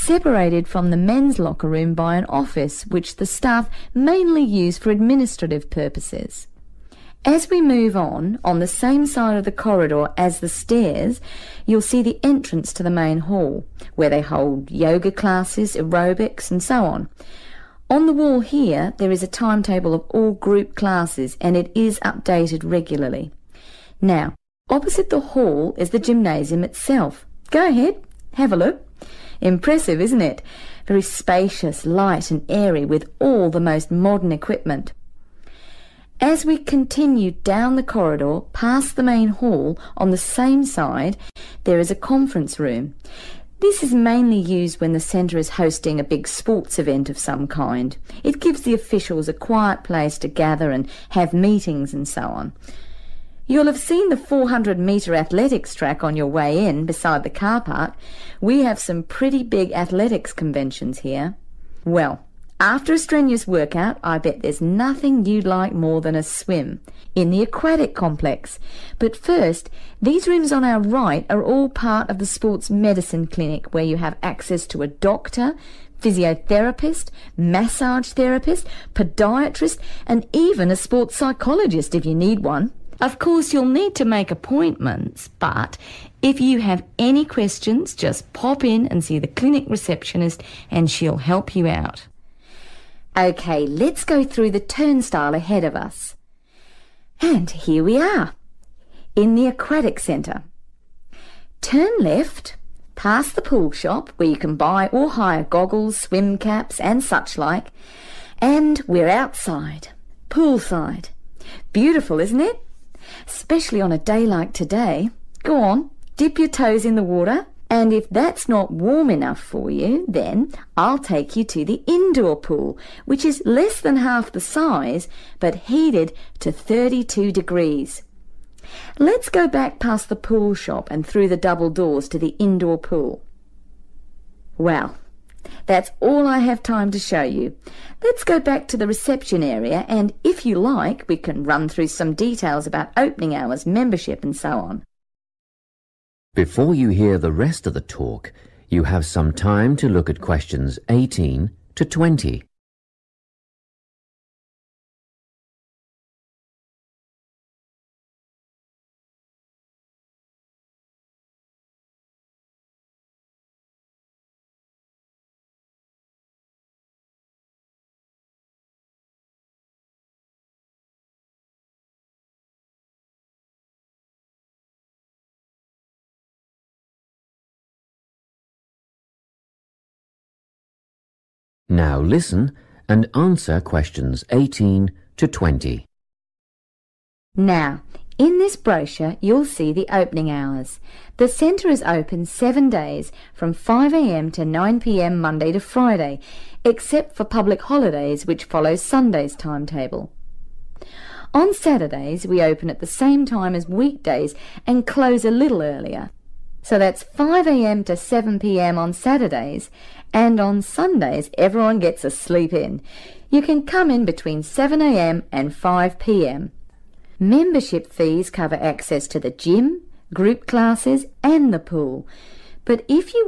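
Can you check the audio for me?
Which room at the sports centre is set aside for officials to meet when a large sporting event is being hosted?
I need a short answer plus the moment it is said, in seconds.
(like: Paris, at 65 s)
conference room, at 41 s.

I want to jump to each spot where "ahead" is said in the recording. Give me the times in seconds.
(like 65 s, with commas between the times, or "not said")
27 s, 95 s.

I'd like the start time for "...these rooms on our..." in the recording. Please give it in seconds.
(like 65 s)
70 s.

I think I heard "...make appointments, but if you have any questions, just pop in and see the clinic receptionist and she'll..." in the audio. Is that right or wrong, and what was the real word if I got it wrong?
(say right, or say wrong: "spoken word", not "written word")
right.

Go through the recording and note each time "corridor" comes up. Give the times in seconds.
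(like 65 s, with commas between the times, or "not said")
9 s, 37 s.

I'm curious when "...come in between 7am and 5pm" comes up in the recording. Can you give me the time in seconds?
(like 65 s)
213 s.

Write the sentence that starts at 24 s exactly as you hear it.
Now, opposite the hall is the gymnasium itself.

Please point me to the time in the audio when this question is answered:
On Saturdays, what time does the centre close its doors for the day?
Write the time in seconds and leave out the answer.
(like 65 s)
207 s.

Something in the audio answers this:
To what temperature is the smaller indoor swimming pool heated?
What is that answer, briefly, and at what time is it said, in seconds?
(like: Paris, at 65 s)
32 degrees, at 126 s.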